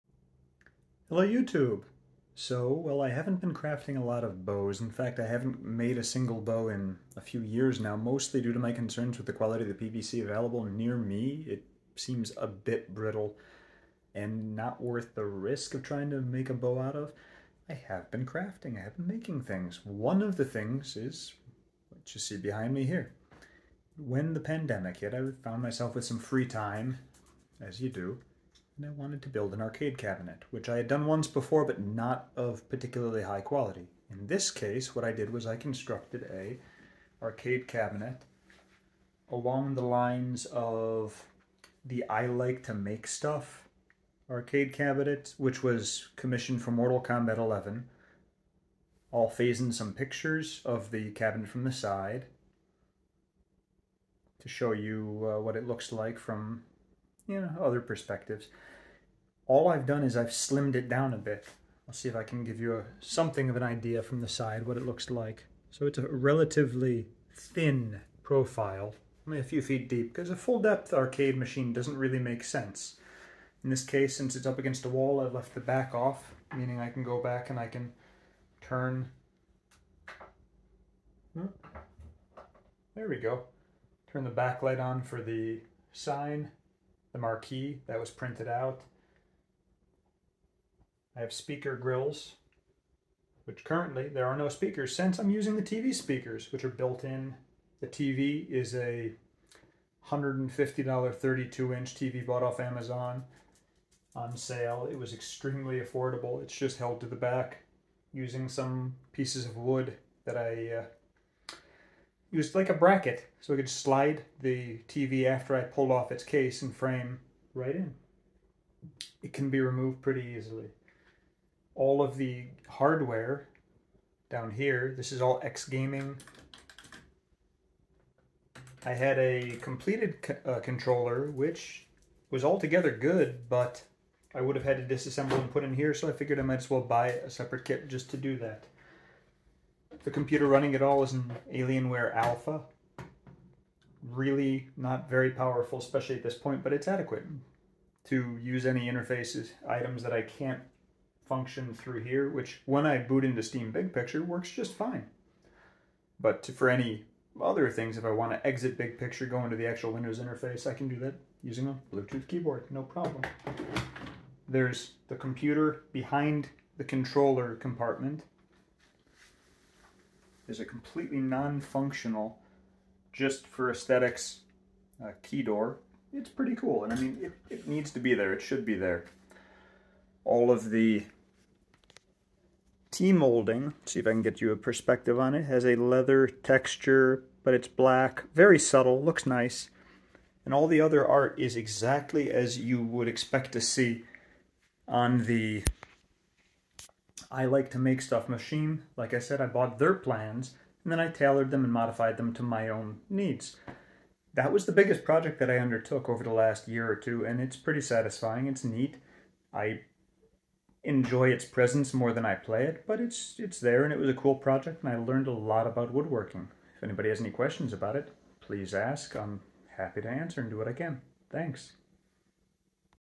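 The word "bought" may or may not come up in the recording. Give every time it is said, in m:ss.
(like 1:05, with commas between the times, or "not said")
1:42, 3:19.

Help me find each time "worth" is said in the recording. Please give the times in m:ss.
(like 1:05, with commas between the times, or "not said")
0:14.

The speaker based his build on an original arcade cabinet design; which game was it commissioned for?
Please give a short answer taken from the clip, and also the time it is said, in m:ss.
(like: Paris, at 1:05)
Mortal Kombat 11, at 0:46.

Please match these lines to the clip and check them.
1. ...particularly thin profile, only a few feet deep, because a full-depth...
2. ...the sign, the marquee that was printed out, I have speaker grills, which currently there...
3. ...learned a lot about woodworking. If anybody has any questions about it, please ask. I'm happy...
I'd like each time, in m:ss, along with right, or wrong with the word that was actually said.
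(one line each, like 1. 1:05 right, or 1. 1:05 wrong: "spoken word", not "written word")
1. 1:06 wrong: "relatively", not "particularly"
2. 1:25 right
3. 3:34 right.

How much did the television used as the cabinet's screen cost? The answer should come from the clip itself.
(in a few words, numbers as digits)
$150.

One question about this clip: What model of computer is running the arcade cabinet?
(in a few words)
Alienware Alpha.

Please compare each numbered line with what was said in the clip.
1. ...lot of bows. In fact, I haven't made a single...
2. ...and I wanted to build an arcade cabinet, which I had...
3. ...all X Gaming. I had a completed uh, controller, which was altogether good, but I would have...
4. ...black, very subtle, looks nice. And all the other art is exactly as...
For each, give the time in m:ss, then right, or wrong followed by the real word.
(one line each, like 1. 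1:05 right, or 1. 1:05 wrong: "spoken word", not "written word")
1. 0:04 right
2. 0:28 right
3. 2:05 right
4. 3:07 right.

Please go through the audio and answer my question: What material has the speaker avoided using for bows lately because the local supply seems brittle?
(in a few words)
PVC.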